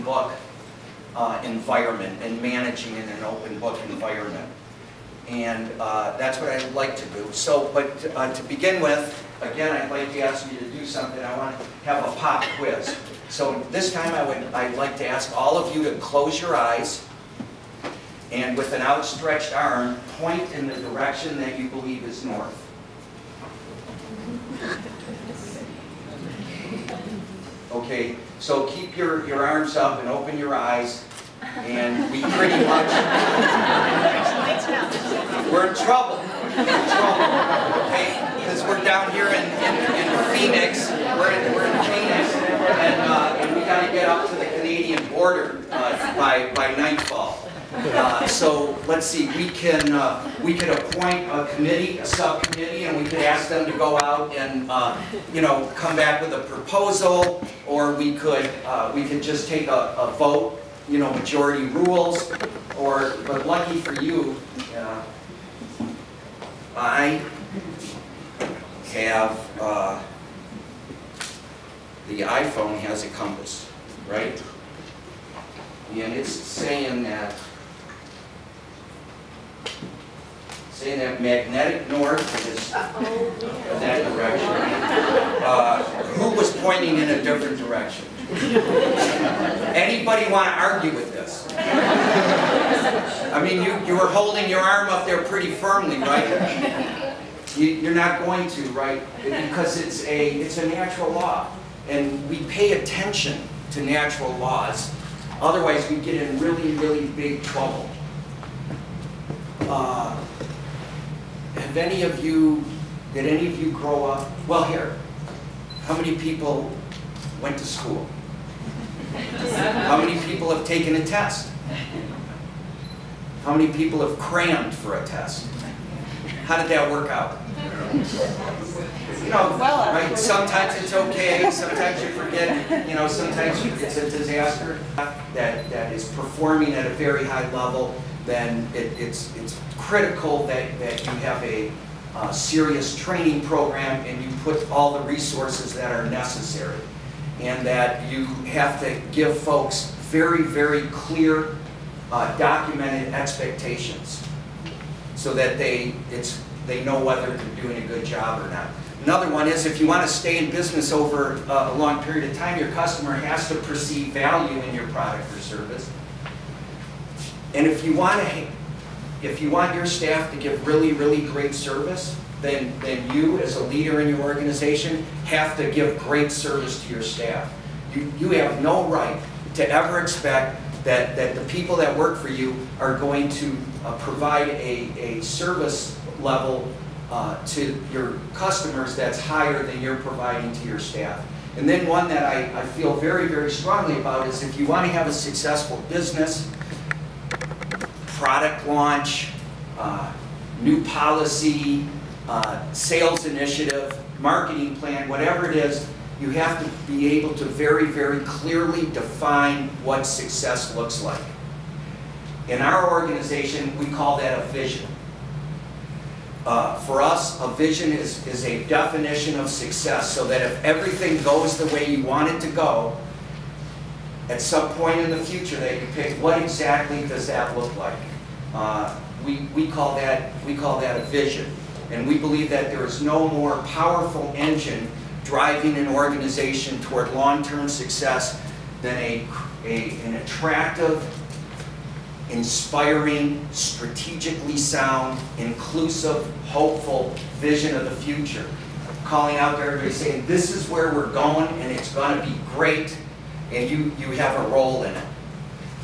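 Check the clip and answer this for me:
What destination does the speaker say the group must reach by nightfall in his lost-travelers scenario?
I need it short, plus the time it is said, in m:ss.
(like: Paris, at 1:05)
The Canadian border, at 0:44.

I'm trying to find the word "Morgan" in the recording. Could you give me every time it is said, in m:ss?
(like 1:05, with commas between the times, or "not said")
not said.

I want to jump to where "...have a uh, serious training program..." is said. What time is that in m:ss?
2:21.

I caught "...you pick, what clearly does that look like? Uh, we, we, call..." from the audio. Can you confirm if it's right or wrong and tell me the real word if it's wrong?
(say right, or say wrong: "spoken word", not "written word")
wrong: "exactly", not "clearly".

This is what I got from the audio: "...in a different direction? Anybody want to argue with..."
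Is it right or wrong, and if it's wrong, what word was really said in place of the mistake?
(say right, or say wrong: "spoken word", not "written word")
right.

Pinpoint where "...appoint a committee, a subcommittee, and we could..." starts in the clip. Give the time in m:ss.
0:50.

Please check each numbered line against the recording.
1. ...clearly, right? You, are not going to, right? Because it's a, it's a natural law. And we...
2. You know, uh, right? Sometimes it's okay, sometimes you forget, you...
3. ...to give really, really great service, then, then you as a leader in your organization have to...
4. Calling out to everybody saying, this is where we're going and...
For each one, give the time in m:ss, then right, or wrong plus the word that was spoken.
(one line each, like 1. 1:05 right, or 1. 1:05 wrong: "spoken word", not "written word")
1. 1:35 wrong: "firmly", not "clearly"
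2. 2:09 right
3. 2:50 right
4. 4:09 right.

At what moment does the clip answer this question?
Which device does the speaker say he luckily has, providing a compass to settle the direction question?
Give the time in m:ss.
1:12.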